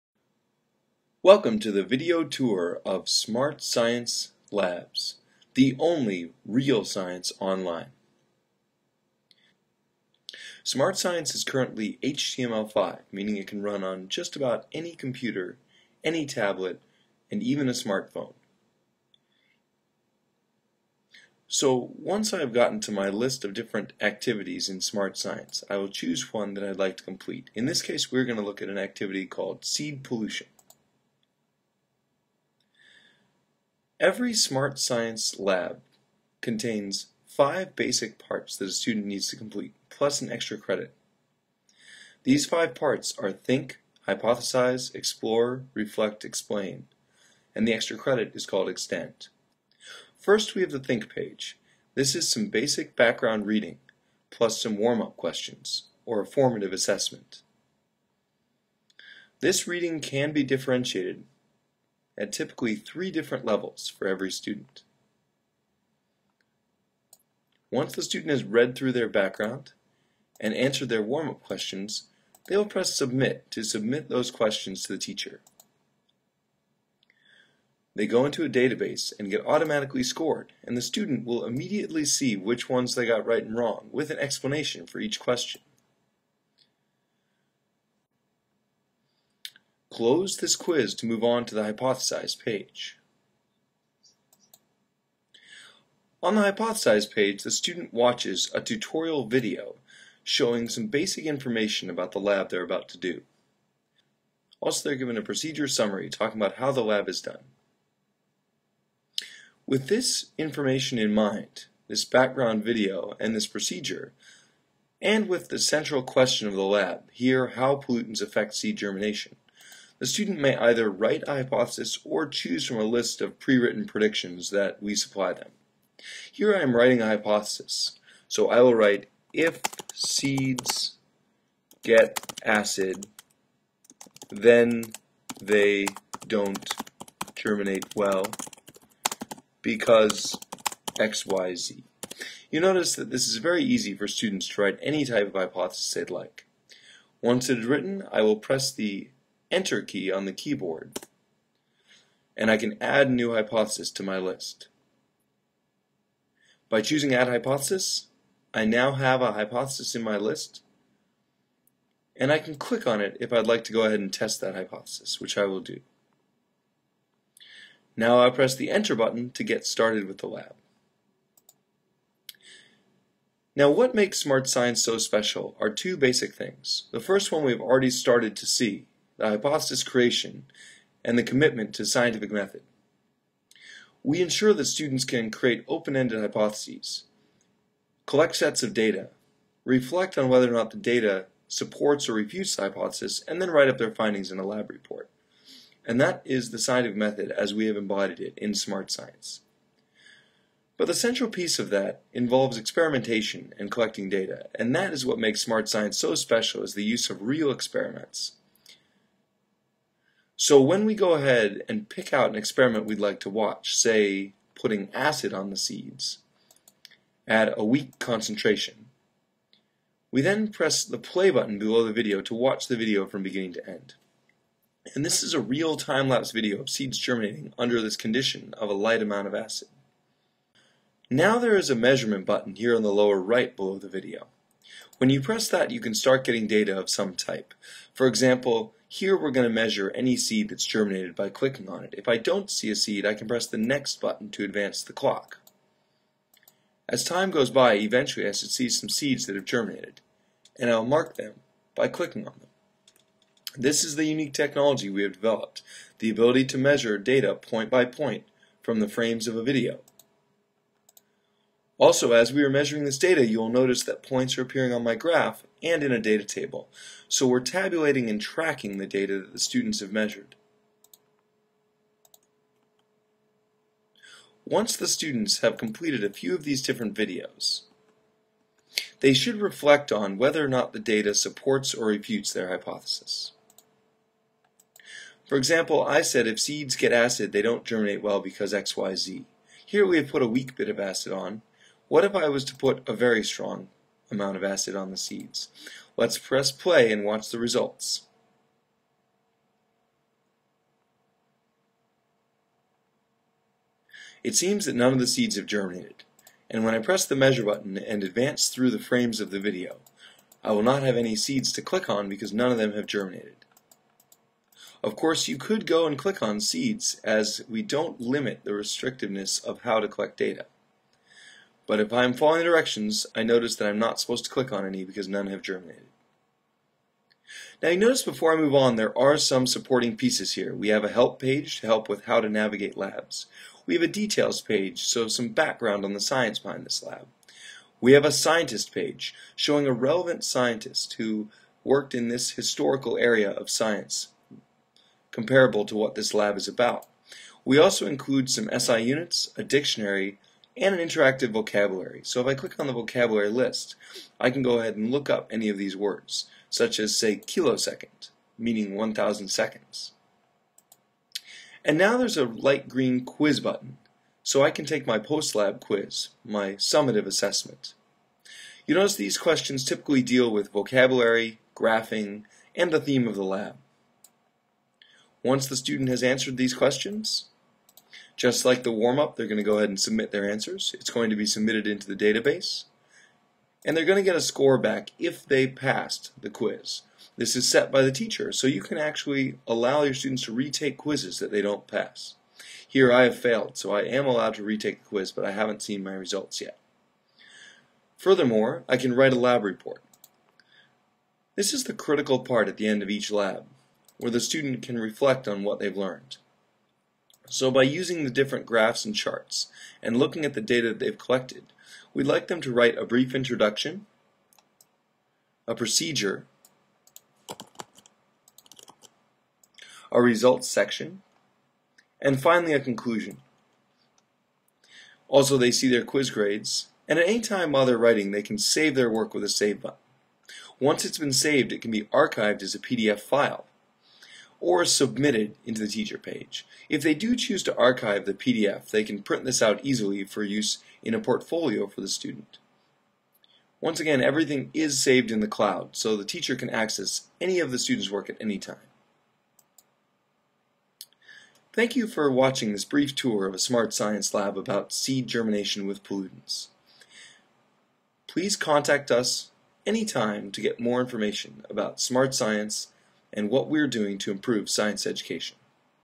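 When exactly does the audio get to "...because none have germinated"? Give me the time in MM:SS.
05:24.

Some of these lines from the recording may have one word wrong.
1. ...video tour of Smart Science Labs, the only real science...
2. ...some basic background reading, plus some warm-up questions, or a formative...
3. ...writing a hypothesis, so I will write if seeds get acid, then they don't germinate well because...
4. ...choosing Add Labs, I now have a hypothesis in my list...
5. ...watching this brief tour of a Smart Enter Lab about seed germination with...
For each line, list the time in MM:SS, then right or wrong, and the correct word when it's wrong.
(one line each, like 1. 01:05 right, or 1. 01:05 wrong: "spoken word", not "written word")
1. 00:01 right
2. 00:52 right
3. 02:06 right
4. 02:36 wrong: "Hypothesis", not "Labs"
5. 07:32 wrong: "Science", not "Enter".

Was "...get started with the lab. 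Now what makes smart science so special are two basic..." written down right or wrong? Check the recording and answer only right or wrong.
right.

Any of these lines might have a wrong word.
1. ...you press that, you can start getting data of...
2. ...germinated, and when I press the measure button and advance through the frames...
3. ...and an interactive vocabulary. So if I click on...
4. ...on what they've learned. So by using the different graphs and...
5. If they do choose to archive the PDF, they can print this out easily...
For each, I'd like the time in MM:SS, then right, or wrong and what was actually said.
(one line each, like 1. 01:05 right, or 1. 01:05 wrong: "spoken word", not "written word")
1. 03:55 right
2. 05:05 right
3. 05:50 right
4. 06:45 right
5. 07:16 right.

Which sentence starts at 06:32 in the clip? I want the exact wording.
Here I have failed, so I am allowed to retake the quiz, but I haven't seen my results yet.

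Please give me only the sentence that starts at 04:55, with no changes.
Let's press play and watch the results.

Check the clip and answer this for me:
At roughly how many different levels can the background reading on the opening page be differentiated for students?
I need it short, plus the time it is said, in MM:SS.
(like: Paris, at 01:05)
3, at 01:02.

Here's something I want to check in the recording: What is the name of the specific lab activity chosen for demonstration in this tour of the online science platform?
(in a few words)
seed pollution.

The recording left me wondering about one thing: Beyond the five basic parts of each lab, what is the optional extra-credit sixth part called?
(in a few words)
extend.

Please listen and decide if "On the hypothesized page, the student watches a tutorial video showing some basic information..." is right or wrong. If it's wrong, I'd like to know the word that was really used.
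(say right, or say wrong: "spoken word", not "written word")
right.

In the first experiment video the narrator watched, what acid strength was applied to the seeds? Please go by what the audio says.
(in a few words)
weak concentration.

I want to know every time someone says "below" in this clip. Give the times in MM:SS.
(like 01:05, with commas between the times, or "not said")
03:41, 03:53.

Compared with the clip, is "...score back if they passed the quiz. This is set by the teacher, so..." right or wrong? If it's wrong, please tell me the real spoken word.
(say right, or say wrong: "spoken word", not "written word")
right.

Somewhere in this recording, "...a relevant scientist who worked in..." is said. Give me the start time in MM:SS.
05:39.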